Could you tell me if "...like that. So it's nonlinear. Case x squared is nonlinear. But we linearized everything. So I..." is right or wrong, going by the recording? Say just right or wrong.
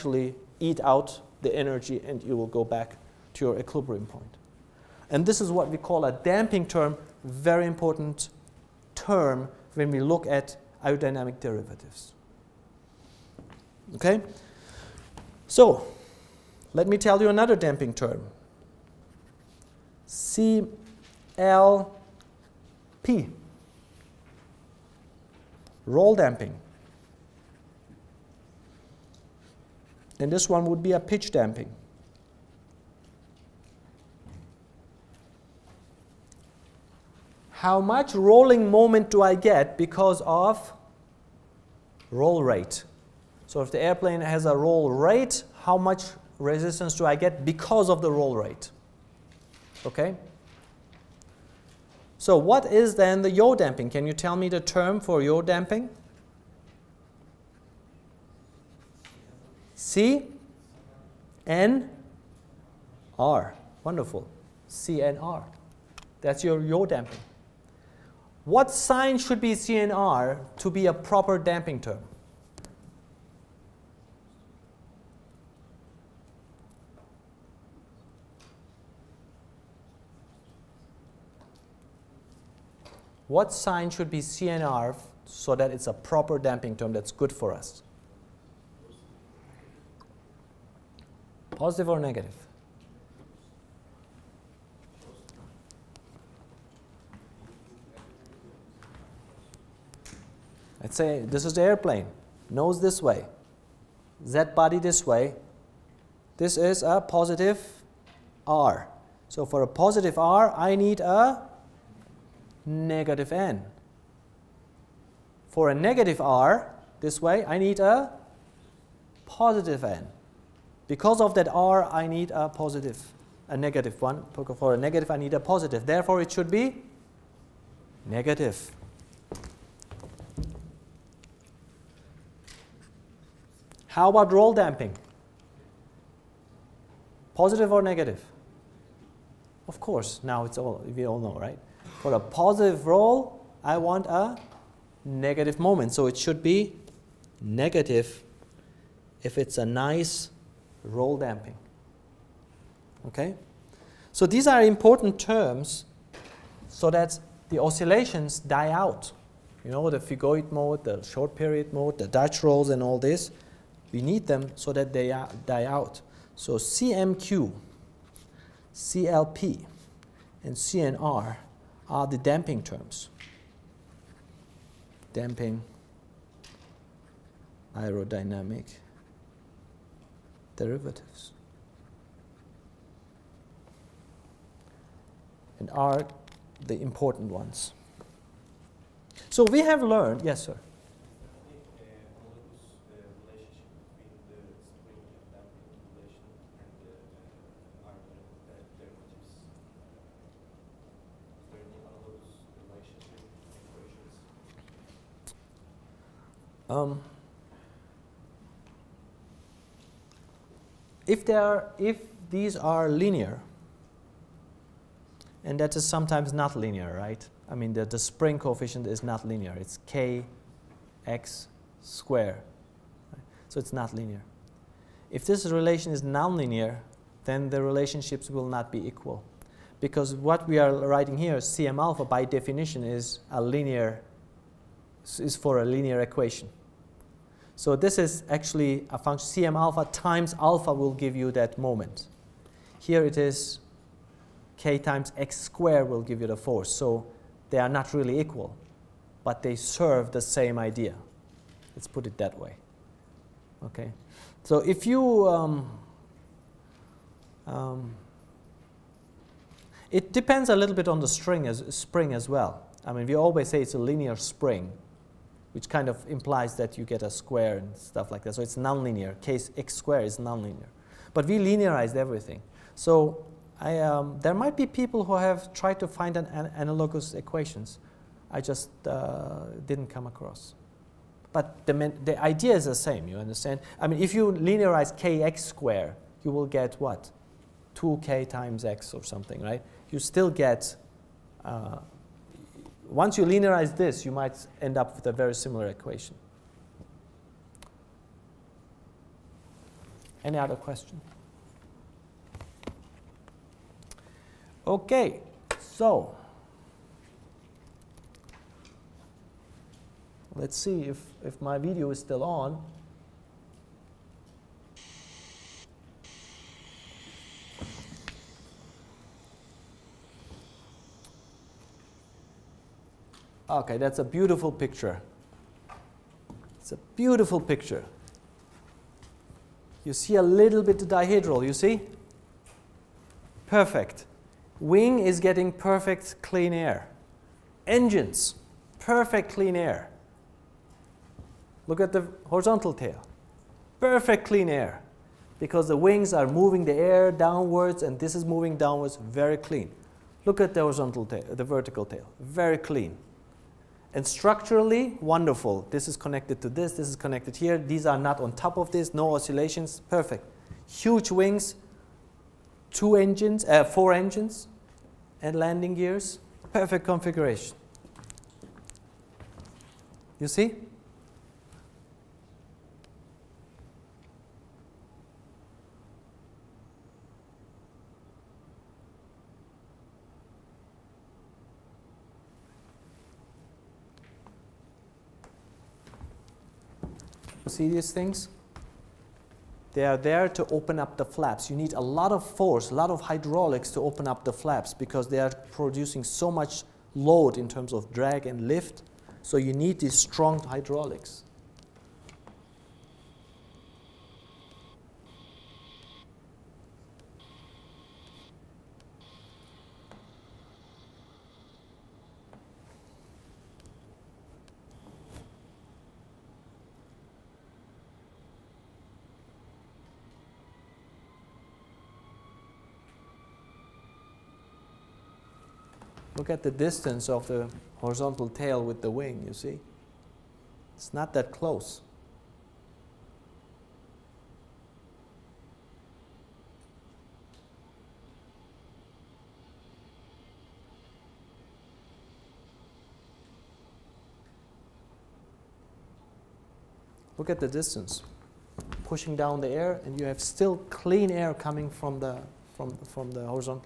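right.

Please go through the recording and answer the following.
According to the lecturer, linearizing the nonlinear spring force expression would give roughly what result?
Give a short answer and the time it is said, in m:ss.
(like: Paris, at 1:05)
2k times x, at 4:47.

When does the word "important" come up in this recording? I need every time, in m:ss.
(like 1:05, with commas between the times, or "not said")
0:07, 2:34, 3:06.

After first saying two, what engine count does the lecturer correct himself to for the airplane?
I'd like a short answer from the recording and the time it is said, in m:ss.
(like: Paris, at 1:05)
4, at 6:03.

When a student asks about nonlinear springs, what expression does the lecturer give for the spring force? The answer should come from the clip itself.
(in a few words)
k times x squared.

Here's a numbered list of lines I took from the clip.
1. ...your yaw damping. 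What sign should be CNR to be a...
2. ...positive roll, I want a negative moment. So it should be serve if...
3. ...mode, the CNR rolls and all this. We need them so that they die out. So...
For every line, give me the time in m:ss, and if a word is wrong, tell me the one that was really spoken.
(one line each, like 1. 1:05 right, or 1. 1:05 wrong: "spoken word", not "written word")
1. 1:06 right
2. 2:22 wrong: "negative", not "serve"
3. 2:41 wrong: "Dutch", not "CNR".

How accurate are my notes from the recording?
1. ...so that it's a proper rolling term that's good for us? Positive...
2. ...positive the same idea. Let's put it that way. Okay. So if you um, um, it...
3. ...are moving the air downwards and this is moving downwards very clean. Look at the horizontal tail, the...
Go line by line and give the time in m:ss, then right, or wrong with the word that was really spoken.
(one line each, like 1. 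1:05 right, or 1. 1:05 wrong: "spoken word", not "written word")
1. 1:25 wrong: "damping", not "rolling"
2. 4:09 wrong: "serve", not "positive"
3. 5:46 right.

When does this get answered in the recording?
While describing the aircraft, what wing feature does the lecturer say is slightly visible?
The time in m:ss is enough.
5:30.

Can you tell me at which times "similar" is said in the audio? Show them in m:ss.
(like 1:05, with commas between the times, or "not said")
4:55.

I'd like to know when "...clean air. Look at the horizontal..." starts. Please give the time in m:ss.
5:39.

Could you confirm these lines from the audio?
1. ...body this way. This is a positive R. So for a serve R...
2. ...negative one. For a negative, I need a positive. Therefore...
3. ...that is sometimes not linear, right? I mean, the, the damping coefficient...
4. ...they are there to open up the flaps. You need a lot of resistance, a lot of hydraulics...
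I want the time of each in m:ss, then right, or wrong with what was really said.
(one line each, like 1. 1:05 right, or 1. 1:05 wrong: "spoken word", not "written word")
1. 1:44 wrong: "positive", not "serve"
2. 2:03 right
3. 3:35 wrong: "spring", not "damping"
4. 6:29 wrong: "force", not "resistance".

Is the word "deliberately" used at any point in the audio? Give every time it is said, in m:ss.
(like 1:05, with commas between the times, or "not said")
not said.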